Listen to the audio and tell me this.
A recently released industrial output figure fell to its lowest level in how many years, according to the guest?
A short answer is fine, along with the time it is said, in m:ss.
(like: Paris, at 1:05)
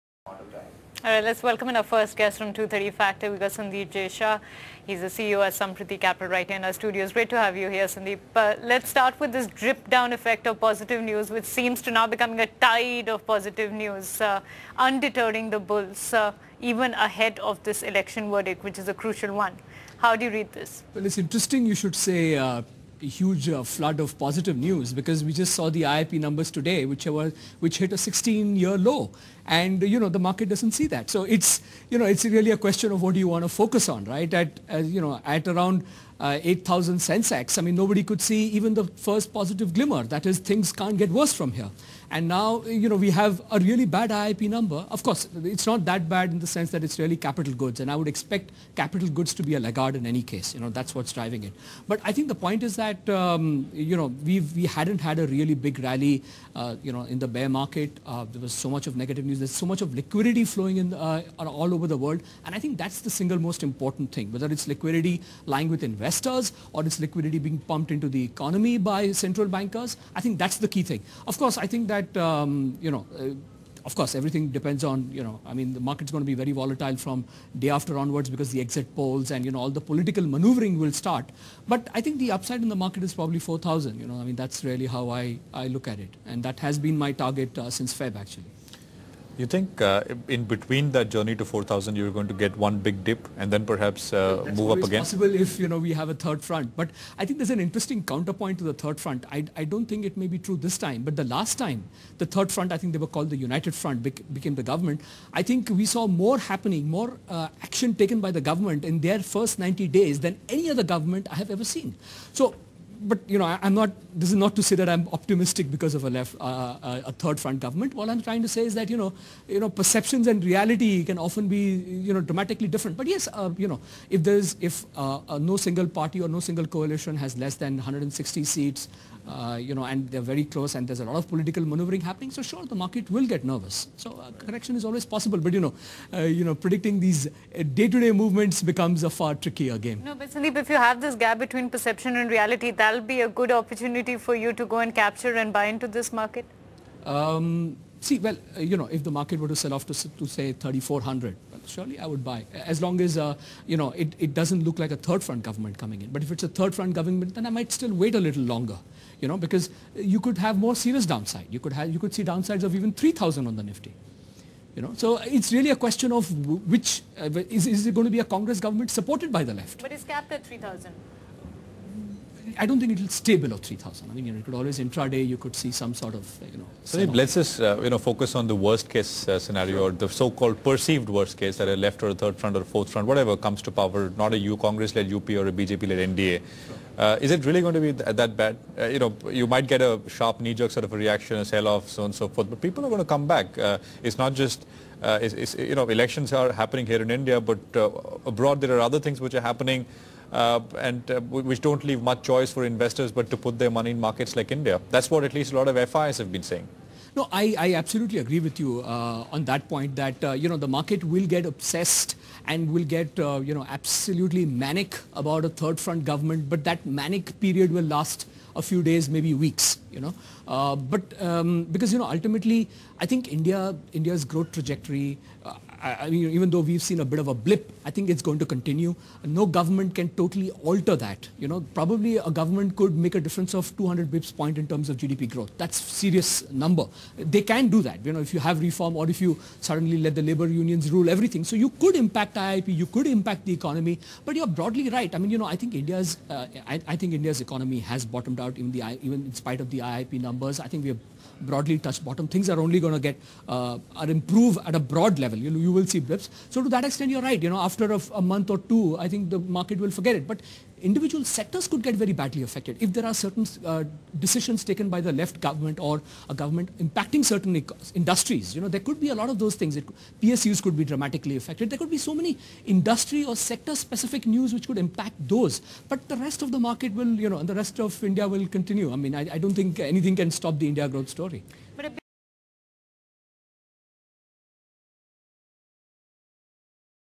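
16, at 0:27.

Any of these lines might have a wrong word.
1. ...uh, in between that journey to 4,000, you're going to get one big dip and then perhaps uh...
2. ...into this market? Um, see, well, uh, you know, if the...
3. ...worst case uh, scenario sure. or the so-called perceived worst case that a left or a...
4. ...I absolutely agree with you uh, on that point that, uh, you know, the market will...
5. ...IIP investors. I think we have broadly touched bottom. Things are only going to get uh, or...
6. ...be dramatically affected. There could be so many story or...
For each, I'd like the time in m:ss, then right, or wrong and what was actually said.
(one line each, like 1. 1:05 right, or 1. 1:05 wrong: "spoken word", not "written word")
1. 1:29 right
2. 2:25 right
3. 2:58 right
4. 3:27 right
5. 4:09 wrong: "numbers", not "investors"
6. 4:30 wrong: "industry", not "story".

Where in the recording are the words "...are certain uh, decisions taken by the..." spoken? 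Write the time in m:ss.
4:23.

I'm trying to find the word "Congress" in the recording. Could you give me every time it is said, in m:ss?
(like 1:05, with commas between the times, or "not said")
2:48, 3:04.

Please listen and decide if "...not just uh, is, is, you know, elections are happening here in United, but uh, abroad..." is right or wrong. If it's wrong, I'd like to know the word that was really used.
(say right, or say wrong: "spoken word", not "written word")
wrong: "India", not "United".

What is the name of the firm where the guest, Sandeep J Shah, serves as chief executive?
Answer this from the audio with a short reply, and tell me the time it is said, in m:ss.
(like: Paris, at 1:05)
Sampriti Capital, at 0:05.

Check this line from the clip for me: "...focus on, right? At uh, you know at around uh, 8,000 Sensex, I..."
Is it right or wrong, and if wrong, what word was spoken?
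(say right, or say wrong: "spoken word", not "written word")
right.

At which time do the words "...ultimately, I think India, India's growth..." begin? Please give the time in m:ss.
3:42.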